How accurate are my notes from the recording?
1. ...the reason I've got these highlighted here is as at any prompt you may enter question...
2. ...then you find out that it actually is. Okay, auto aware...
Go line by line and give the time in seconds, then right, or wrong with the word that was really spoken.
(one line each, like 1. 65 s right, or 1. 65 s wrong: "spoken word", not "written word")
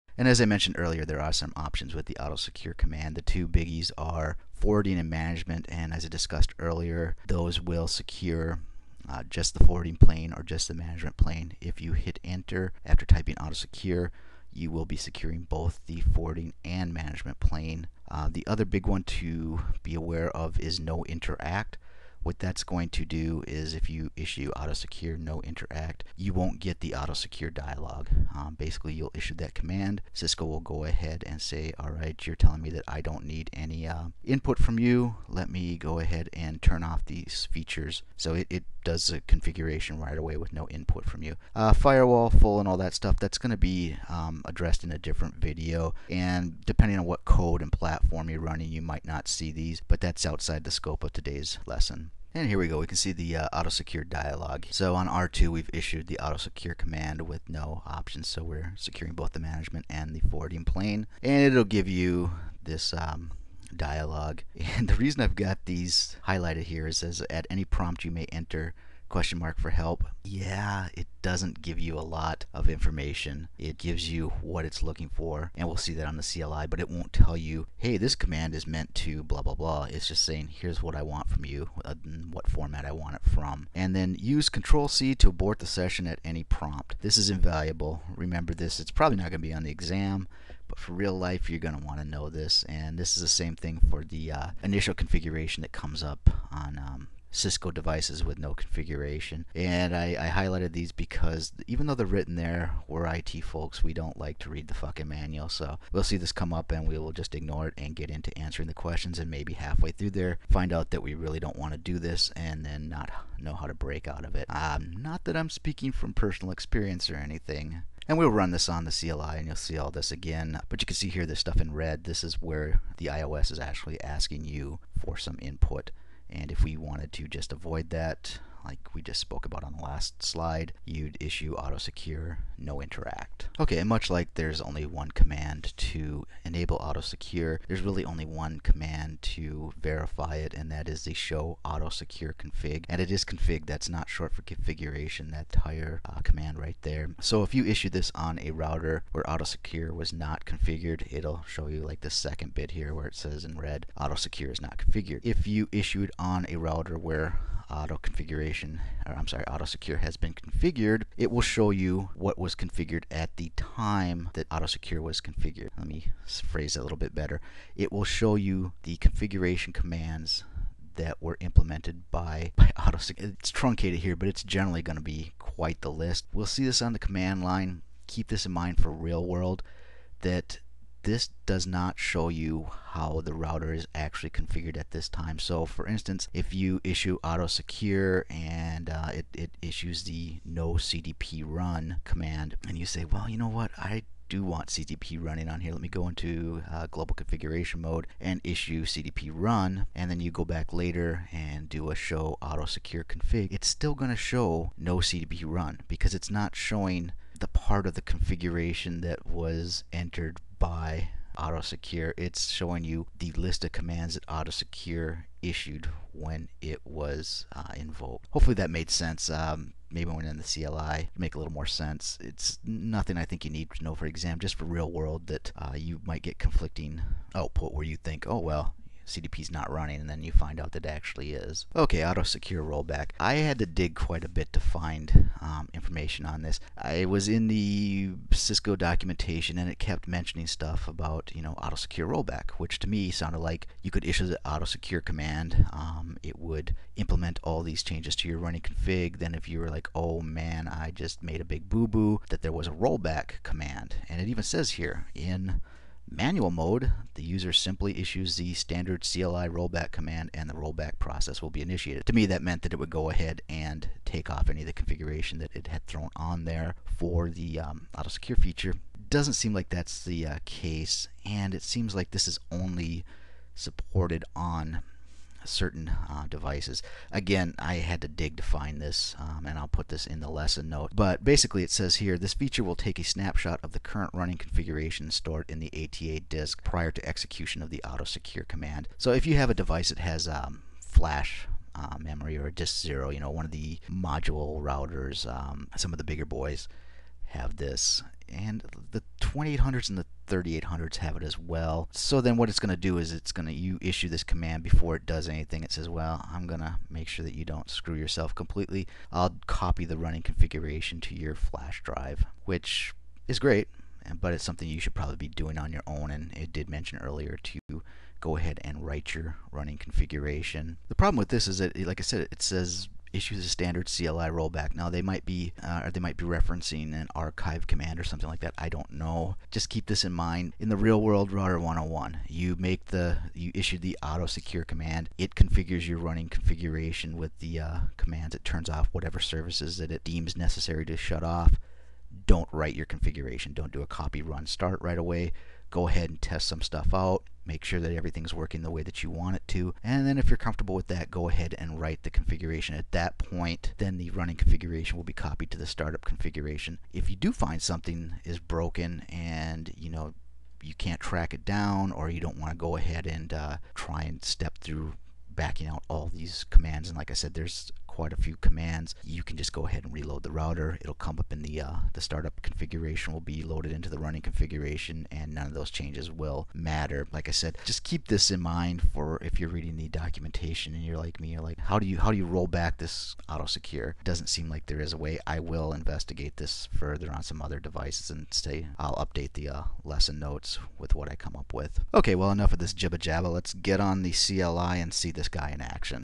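1. 64 s right
2. 230 s wrong: "secure", not "aware".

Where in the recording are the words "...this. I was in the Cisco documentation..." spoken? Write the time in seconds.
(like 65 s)
236 s.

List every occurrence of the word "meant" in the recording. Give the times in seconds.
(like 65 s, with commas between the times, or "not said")
78 s, 262 s.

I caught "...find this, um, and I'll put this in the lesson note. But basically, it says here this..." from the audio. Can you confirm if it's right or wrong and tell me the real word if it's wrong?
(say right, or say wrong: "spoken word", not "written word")
right.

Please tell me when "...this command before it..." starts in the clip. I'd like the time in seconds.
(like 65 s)
304 s.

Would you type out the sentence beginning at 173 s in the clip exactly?
It's truncated here, but it's generally going to be quite the list.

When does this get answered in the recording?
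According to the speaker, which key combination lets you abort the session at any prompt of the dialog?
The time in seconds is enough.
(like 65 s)
84 s.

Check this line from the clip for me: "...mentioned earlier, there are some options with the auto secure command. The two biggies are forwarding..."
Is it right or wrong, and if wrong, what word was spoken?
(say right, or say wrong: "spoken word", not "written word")
right.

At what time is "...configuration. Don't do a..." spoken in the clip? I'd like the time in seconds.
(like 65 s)
342 s.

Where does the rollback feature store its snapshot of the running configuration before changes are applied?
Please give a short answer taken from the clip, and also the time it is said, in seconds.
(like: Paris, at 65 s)
ATA disk, at 285 s.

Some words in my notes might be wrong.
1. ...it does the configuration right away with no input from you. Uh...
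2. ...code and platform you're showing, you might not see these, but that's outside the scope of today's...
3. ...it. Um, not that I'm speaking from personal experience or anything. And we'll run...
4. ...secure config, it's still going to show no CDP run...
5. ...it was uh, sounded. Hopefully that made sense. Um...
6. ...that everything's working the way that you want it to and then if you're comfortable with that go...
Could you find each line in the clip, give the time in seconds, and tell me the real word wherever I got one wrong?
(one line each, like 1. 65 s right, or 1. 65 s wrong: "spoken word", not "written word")
1. 38 s right
2. 47 s wrong: "running", not "showing"
3. 114 s right
4. 202 s right
5. 216 s wrong: "invoked", not "sounded"
6. 347 s right.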